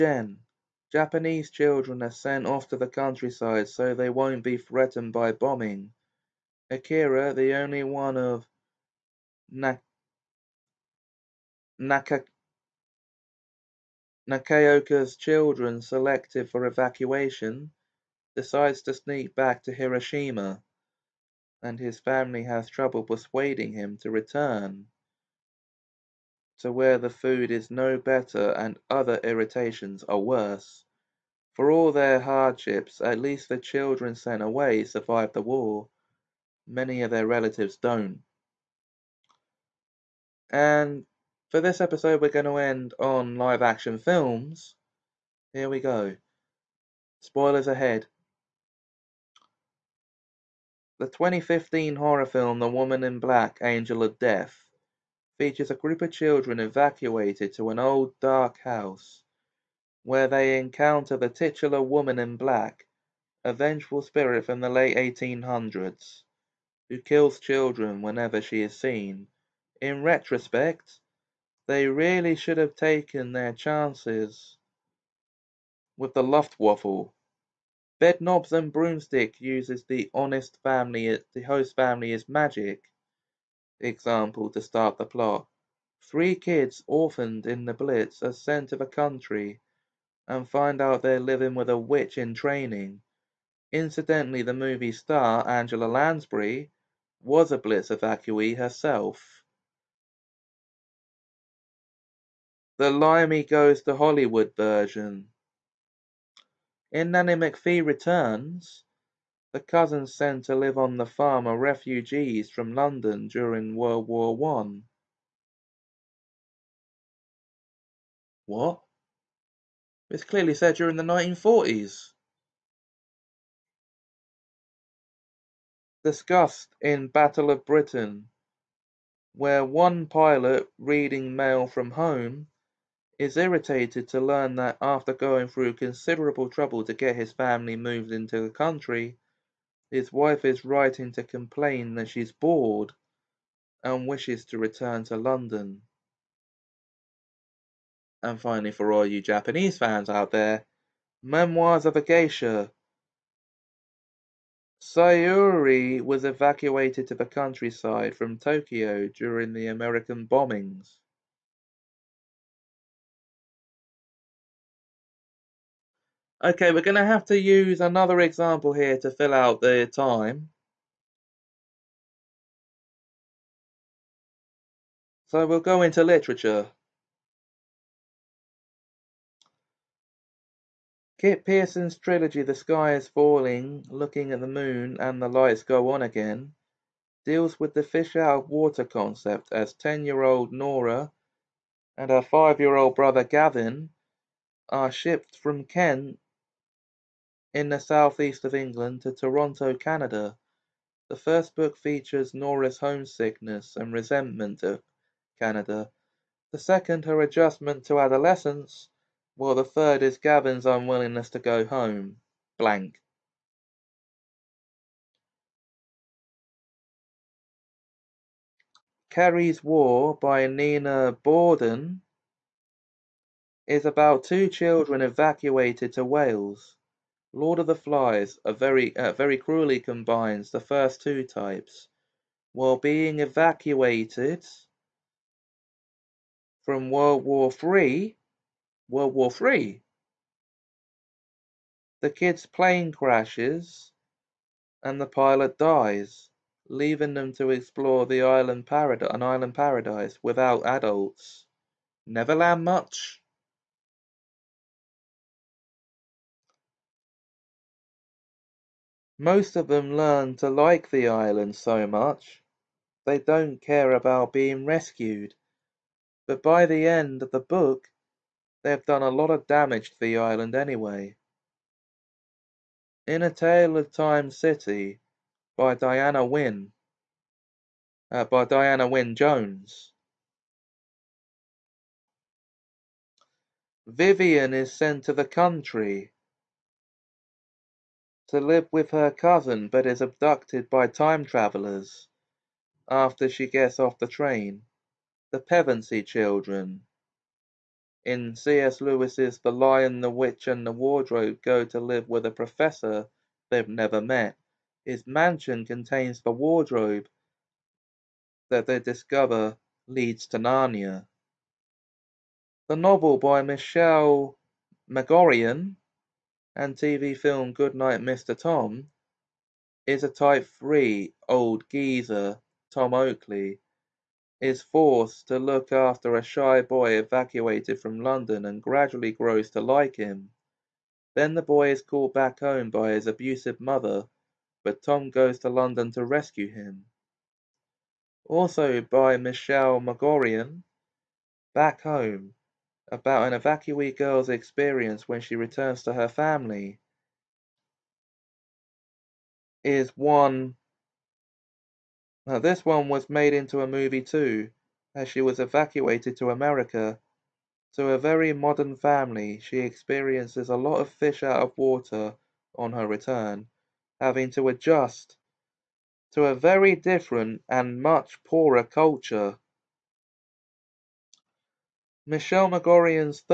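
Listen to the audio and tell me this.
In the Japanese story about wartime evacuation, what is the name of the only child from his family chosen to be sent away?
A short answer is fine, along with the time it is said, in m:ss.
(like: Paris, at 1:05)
Akira, at 0:06.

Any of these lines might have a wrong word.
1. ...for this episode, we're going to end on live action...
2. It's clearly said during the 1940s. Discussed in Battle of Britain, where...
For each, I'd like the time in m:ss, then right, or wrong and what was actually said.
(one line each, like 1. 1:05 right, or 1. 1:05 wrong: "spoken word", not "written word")
1. 0:41 right
2. 2:00 right.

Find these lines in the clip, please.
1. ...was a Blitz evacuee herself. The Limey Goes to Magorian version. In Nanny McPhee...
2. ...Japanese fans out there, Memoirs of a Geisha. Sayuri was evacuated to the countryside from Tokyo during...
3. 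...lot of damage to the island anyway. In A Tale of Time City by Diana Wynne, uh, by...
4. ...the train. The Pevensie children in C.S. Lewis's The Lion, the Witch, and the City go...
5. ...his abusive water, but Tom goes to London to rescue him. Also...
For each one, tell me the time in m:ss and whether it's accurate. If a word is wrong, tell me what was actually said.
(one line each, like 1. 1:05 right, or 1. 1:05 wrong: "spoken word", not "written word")
1. 1:37 wrong: "Hollywood", not "Magorian"
2. 2:29 right
3. 4:29 right
4. 4:53 wrong: "Wardrobe", not "City"
5. 5:32 wrong: "mother", not "water".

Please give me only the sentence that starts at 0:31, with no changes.
For all their hardships, at least the children sent away survived the war.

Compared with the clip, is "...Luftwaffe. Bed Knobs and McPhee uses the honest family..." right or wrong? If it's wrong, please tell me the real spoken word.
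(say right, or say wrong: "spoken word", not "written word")
wrong: "Broomstick", not "McPhee".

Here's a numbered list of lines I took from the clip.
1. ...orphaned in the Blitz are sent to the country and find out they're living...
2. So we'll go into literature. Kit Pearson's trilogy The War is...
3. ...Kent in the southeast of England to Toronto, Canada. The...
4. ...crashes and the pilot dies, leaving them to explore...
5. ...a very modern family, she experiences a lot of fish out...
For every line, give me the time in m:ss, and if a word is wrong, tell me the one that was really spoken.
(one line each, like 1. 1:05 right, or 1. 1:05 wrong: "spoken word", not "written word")
1. 1:26 right
2. 2:55 wrong: "Sky", not "War"
3. 3:15 right
4. 4:02 right
5. 5:57 right.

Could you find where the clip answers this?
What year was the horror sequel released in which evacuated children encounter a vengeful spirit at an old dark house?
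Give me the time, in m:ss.
0:51.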